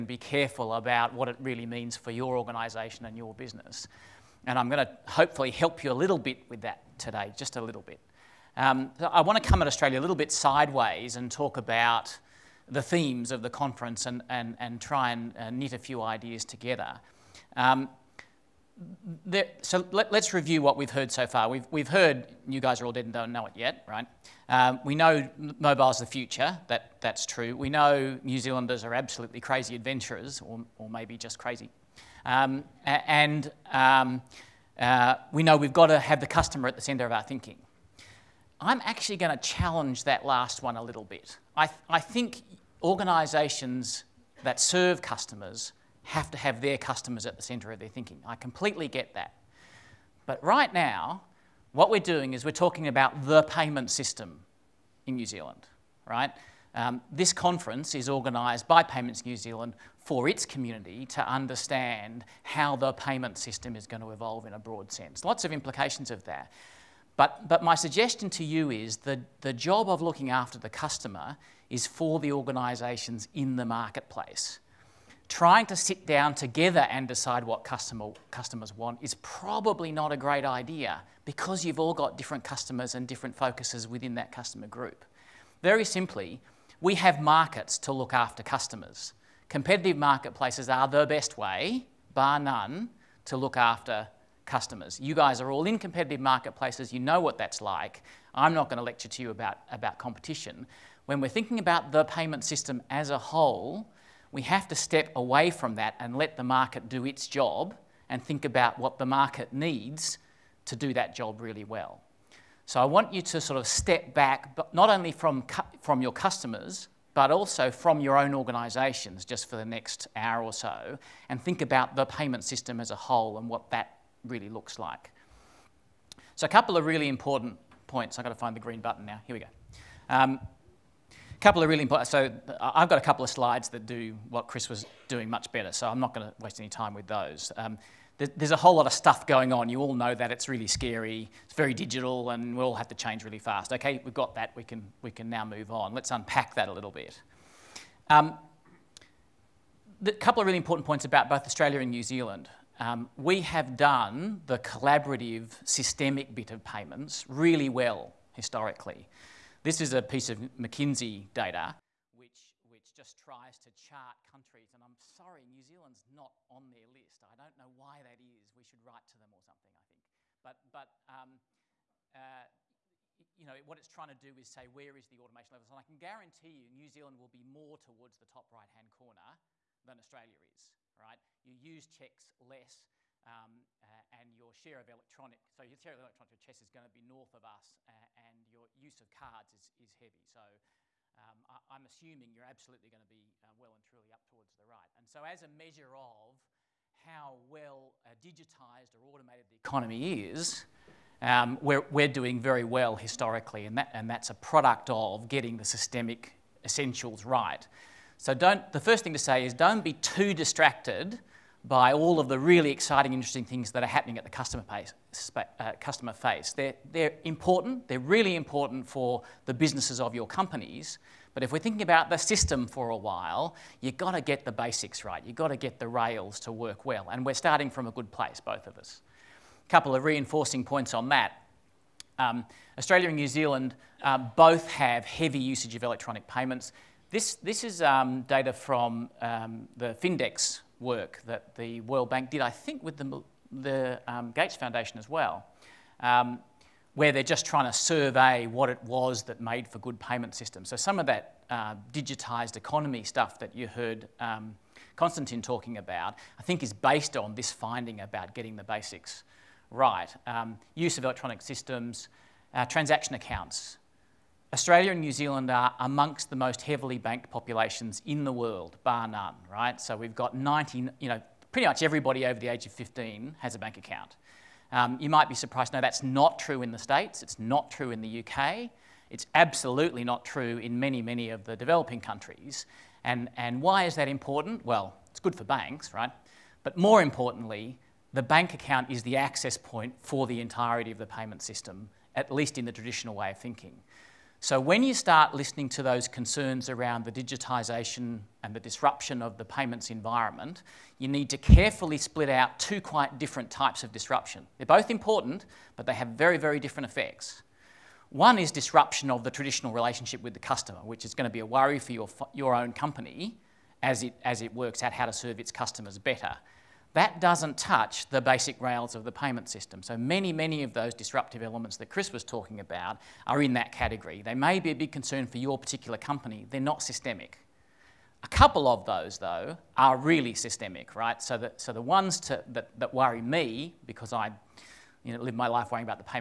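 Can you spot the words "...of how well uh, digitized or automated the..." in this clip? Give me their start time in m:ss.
3:15.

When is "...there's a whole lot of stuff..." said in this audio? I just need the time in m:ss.
2:18.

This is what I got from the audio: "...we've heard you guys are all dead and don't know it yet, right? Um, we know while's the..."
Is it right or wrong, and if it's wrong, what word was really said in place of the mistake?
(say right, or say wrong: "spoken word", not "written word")
wrong: "mobile", not "while".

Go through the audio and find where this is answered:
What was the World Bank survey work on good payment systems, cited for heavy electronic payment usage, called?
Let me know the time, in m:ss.
4:00.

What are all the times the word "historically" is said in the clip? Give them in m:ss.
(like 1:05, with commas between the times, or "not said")
2:38, 3:22.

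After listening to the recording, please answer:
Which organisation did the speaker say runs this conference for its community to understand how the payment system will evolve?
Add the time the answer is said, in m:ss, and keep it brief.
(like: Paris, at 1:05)
Payments New Zealand, at 0:58.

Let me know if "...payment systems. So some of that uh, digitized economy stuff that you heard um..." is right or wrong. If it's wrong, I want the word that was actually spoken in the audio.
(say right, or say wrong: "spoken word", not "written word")
right.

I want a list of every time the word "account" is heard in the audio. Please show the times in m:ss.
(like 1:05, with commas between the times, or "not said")
4:23, 4:33, 4:48.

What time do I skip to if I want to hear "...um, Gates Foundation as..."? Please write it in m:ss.
4:04.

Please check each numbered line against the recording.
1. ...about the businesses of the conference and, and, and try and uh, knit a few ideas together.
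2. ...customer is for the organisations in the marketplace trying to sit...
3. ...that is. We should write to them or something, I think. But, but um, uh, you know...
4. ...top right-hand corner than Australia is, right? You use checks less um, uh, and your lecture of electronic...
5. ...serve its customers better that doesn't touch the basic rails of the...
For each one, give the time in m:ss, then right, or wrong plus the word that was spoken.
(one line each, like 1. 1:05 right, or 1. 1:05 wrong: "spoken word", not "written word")
1. 0:11 wrong: "themes", not "businesses"
2. 1:10 right
3. 2:48 right
4. 2:58 wrong: "share", not "lecture"
5. 5:15 right.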